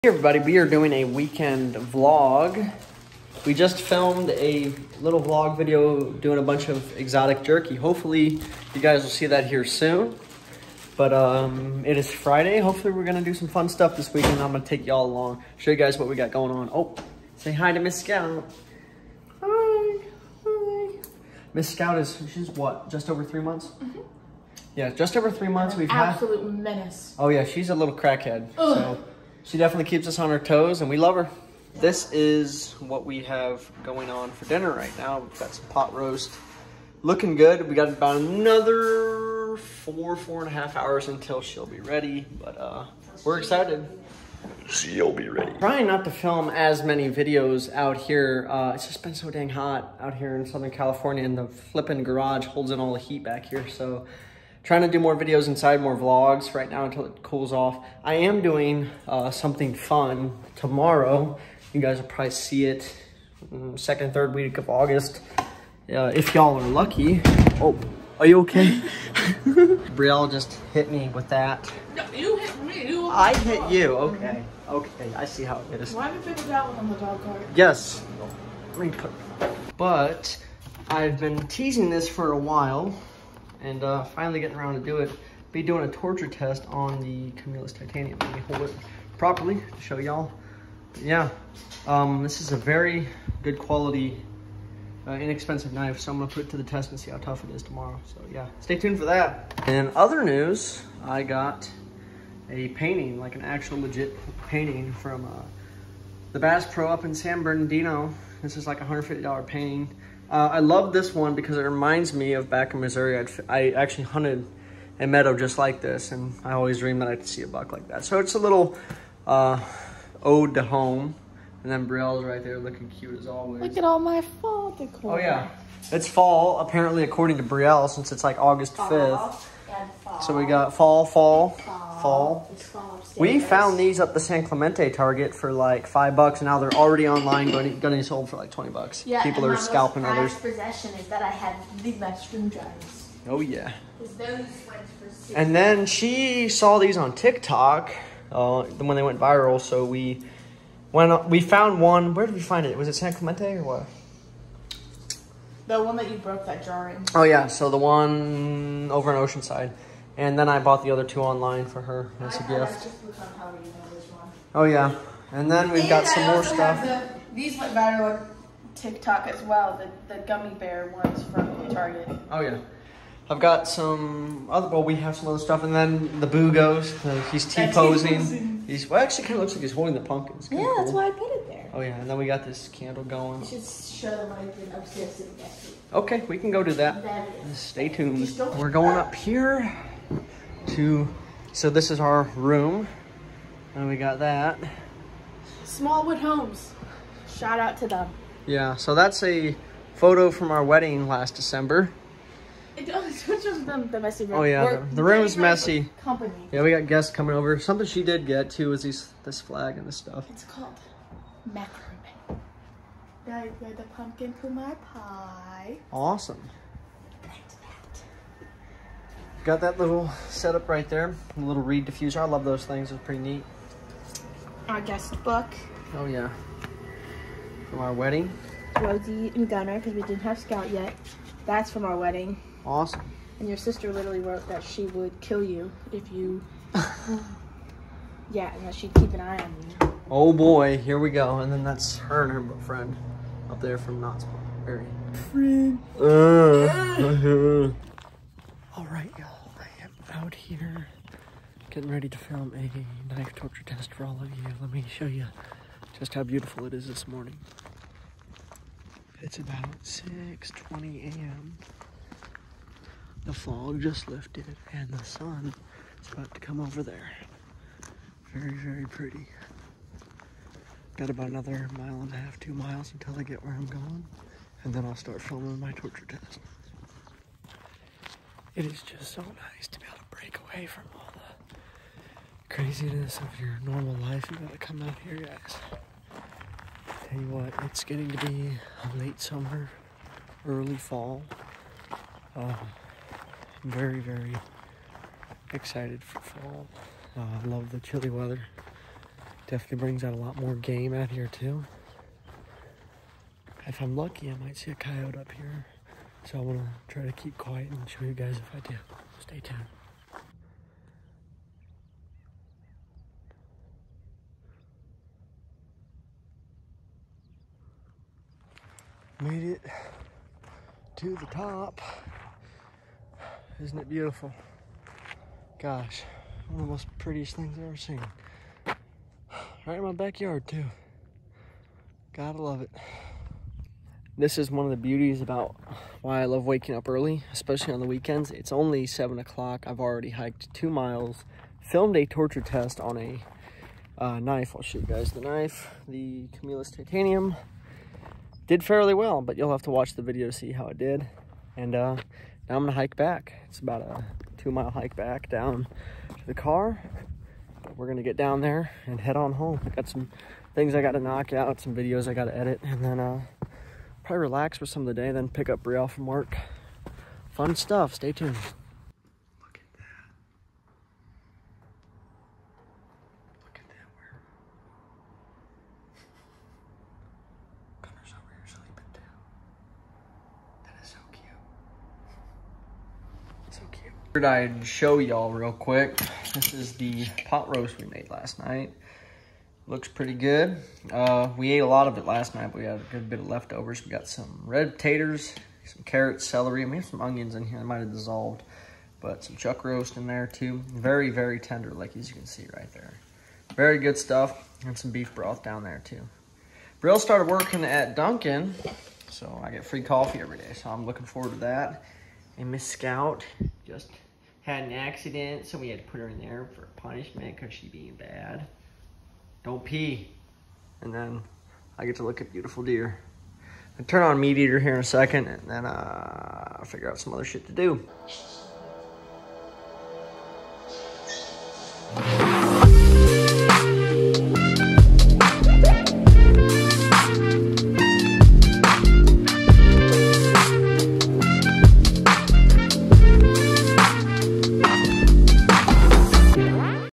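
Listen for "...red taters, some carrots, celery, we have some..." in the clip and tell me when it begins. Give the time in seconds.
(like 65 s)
394 s.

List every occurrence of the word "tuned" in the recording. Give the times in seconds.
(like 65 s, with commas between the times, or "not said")
98 s, 187 s, 309 s, 368 s.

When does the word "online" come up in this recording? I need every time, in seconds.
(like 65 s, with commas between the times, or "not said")
137 s, 161 s.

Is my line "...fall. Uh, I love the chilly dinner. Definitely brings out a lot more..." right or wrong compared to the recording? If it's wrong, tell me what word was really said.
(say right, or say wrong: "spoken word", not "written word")
wrong: "weather", not "dinner".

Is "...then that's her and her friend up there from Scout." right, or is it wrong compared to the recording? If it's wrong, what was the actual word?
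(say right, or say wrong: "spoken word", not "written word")
wrong: "Knoxville", not "Scout".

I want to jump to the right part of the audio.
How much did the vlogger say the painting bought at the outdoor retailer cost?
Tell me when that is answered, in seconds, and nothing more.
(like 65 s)
108 s.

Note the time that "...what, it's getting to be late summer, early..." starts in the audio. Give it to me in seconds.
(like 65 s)
287 s.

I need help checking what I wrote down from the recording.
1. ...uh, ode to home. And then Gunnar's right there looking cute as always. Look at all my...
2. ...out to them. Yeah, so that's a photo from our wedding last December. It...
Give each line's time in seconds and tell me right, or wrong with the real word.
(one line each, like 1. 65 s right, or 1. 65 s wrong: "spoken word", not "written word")
1. 119 s wrong: "Brielle", not "Gunnar"
2. 197 s right.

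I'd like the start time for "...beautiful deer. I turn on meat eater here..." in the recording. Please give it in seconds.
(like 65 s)
422 s.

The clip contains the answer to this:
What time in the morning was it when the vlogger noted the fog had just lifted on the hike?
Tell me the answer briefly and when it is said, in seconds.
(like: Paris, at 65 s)
6:20 a.m., at 259 s.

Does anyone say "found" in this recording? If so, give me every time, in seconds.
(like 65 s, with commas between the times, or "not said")
133 s, 151 s.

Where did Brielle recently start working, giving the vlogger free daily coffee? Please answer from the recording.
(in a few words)
Dunkin'.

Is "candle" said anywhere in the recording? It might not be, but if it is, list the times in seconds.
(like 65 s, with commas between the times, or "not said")
182 s.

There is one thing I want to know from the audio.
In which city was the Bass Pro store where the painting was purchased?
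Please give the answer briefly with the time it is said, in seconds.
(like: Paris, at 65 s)
San Bernardino, at 107 s.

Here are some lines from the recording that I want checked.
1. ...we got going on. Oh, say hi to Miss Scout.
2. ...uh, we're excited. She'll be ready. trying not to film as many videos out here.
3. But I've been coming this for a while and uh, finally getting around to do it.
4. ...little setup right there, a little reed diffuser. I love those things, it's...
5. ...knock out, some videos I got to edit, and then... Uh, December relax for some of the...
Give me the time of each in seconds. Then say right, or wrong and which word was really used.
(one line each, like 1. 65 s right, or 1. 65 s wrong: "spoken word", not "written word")
1. 16 s right
2. 42 s right
3. 79 s wrong: "teasing", not "coming"
4. 219 s right
5. 360 s wrong: "Probably", not "December".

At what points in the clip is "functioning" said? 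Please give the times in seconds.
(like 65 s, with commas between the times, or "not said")
not said.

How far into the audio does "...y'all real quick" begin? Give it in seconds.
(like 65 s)
384 s.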